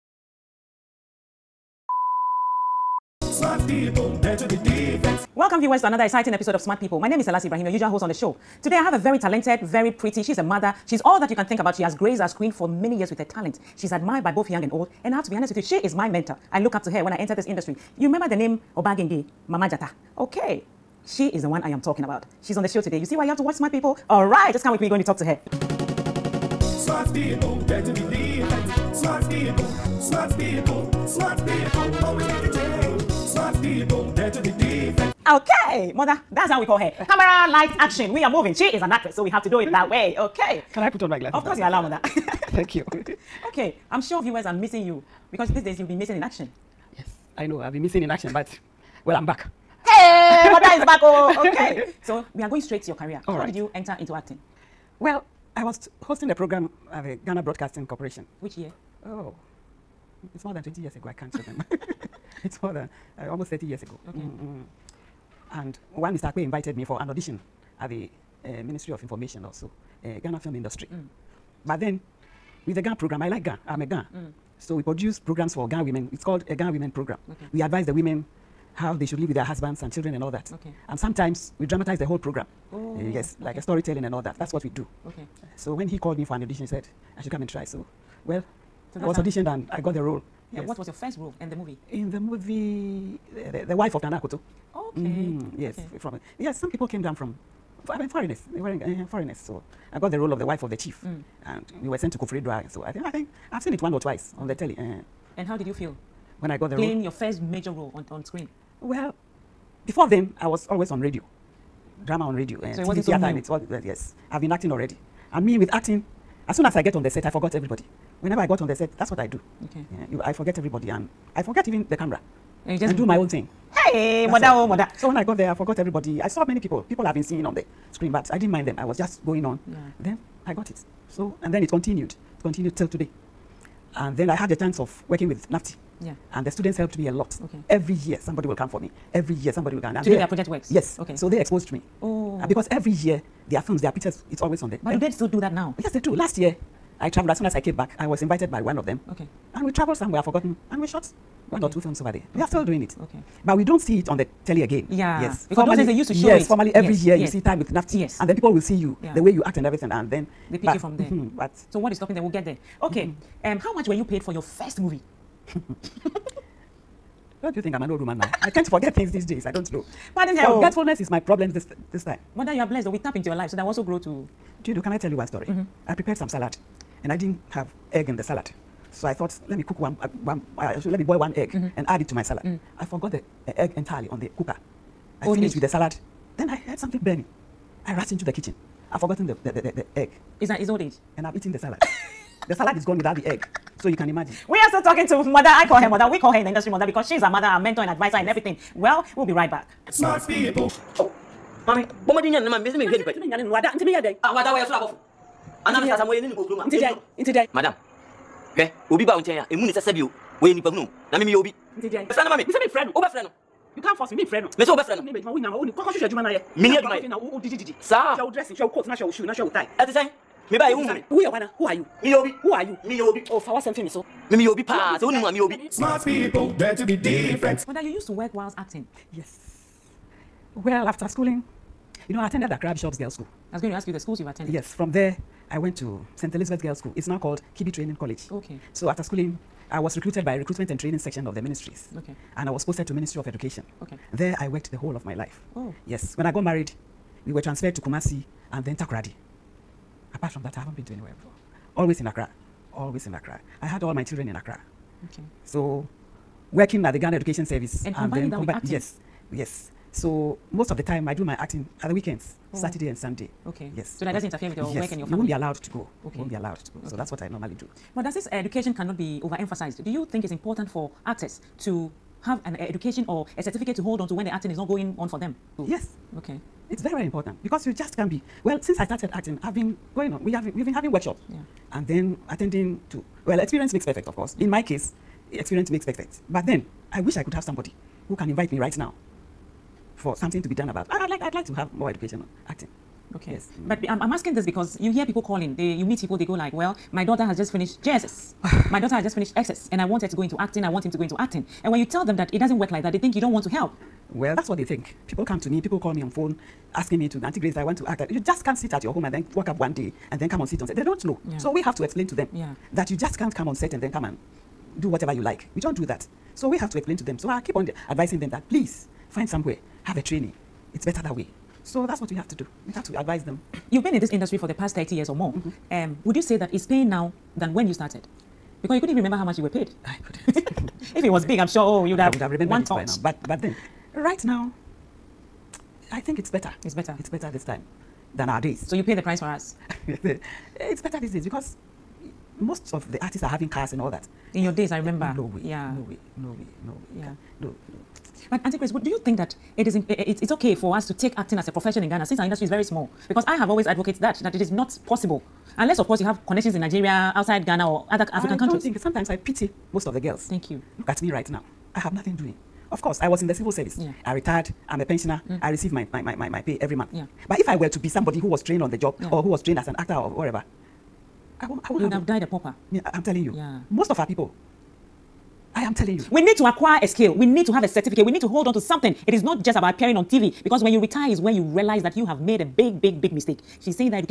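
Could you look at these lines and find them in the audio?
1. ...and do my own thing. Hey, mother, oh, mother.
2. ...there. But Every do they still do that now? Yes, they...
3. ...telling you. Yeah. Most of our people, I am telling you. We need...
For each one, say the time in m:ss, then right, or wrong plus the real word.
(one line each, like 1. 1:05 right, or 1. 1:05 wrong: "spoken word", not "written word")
1. 2:02 right
2. 2:24 right
3. 6:13 right.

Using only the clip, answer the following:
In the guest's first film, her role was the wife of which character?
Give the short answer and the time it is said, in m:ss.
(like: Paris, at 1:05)
Nana Akoto, at 1:34.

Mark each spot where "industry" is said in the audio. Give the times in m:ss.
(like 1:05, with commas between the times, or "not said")
0:17, 1:10, 3:16, 5:24, 5:52.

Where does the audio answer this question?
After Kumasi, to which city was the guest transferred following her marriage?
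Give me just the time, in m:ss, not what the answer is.
4:08.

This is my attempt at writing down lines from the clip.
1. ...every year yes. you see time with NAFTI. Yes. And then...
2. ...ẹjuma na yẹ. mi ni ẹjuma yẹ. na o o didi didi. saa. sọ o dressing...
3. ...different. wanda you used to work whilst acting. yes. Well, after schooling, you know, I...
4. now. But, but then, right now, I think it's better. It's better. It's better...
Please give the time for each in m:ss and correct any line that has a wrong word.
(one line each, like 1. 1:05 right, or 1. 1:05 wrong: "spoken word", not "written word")
1. 2:36 right
2. 3:36 right
3. 3:46 right
4. 5:32 right.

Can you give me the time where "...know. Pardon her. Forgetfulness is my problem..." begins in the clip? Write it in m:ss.
2:49.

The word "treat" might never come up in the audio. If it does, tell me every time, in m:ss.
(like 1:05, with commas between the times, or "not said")
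not said.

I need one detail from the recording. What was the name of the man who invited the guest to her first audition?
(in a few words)
Mr. Akwe.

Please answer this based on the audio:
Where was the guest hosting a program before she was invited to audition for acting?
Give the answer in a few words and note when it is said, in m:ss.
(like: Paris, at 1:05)
Ghana Broadcasting Corporation, at 0:57.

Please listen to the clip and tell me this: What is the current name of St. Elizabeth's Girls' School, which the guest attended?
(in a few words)
Kibi Training College.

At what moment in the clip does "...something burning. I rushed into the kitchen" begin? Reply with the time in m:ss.
3:06.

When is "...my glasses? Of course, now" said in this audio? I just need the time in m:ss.
0:41.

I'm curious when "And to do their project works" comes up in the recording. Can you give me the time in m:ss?
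2:19.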